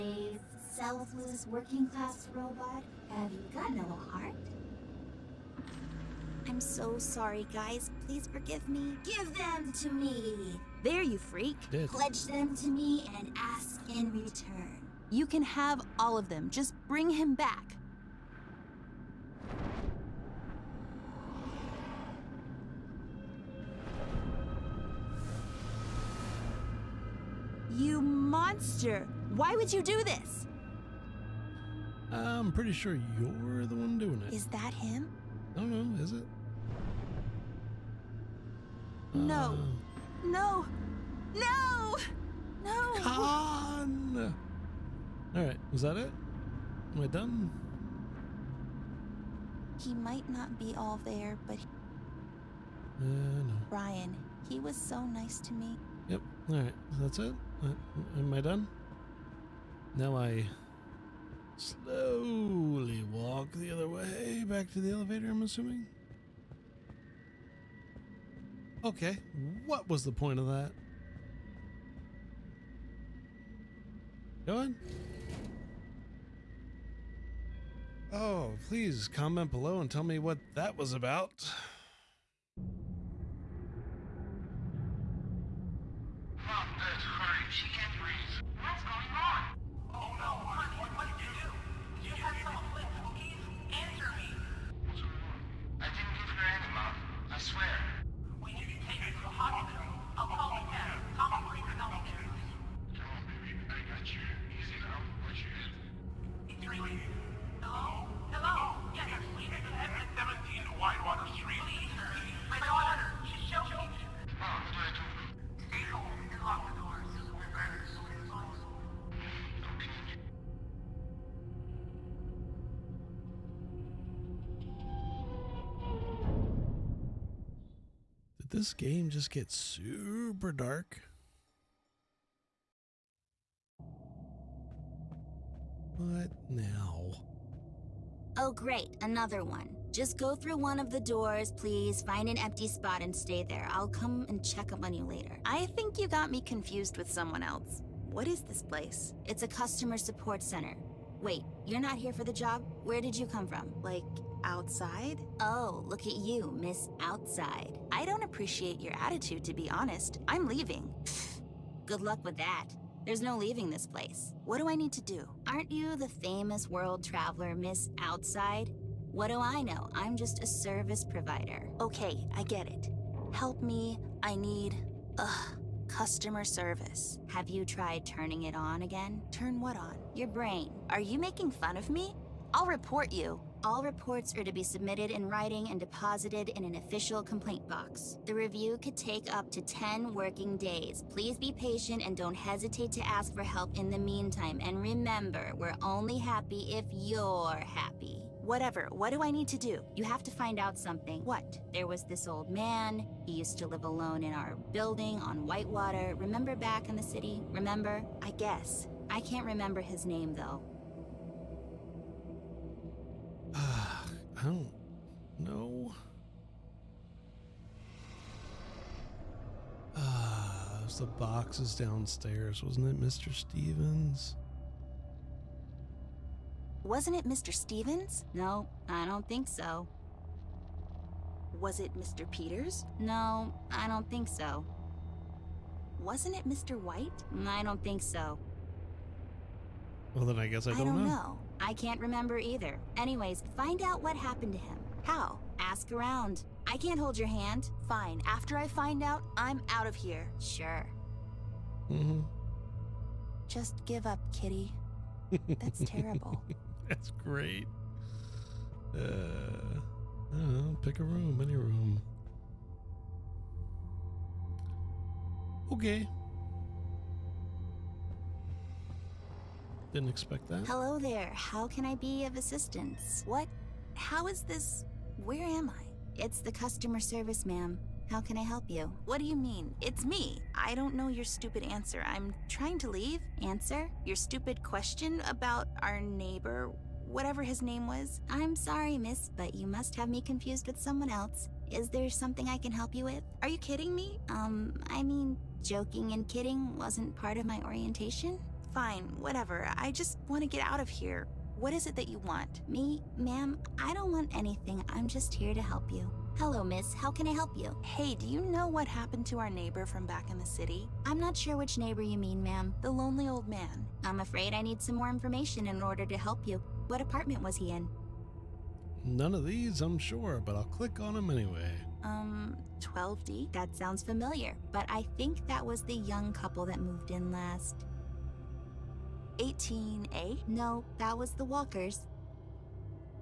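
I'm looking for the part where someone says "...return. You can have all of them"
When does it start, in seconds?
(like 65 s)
14 s.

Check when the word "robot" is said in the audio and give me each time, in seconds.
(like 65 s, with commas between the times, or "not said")
2 s.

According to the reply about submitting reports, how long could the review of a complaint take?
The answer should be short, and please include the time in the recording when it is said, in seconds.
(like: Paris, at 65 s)
10 working days, at 189 s.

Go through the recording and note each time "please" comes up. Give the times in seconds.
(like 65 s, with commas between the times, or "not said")
8 s, 78 s, 141 s, 191 s.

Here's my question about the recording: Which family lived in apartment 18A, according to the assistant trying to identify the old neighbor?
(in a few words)
The Walkers.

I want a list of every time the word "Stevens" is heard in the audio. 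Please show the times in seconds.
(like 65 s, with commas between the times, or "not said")
223 s, 227 s.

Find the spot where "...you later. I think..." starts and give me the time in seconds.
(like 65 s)
144 s.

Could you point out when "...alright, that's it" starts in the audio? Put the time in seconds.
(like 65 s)
56 s.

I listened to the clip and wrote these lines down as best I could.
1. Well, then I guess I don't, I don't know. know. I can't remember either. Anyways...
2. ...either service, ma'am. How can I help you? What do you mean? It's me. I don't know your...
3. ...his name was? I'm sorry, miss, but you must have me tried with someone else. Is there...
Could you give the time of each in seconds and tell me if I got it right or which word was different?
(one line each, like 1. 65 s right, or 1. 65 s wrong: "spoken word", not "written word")
1. 240 s right
2. 276 s wrong: "customer", not "either"
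3. 287 s wrong: "confused", not "tried".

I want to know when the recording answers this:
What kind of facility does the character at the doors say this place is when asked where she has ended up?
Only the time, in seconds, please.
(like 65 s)
149 s.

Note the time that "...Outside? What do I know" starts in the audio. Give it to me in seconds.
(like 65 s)
168 s.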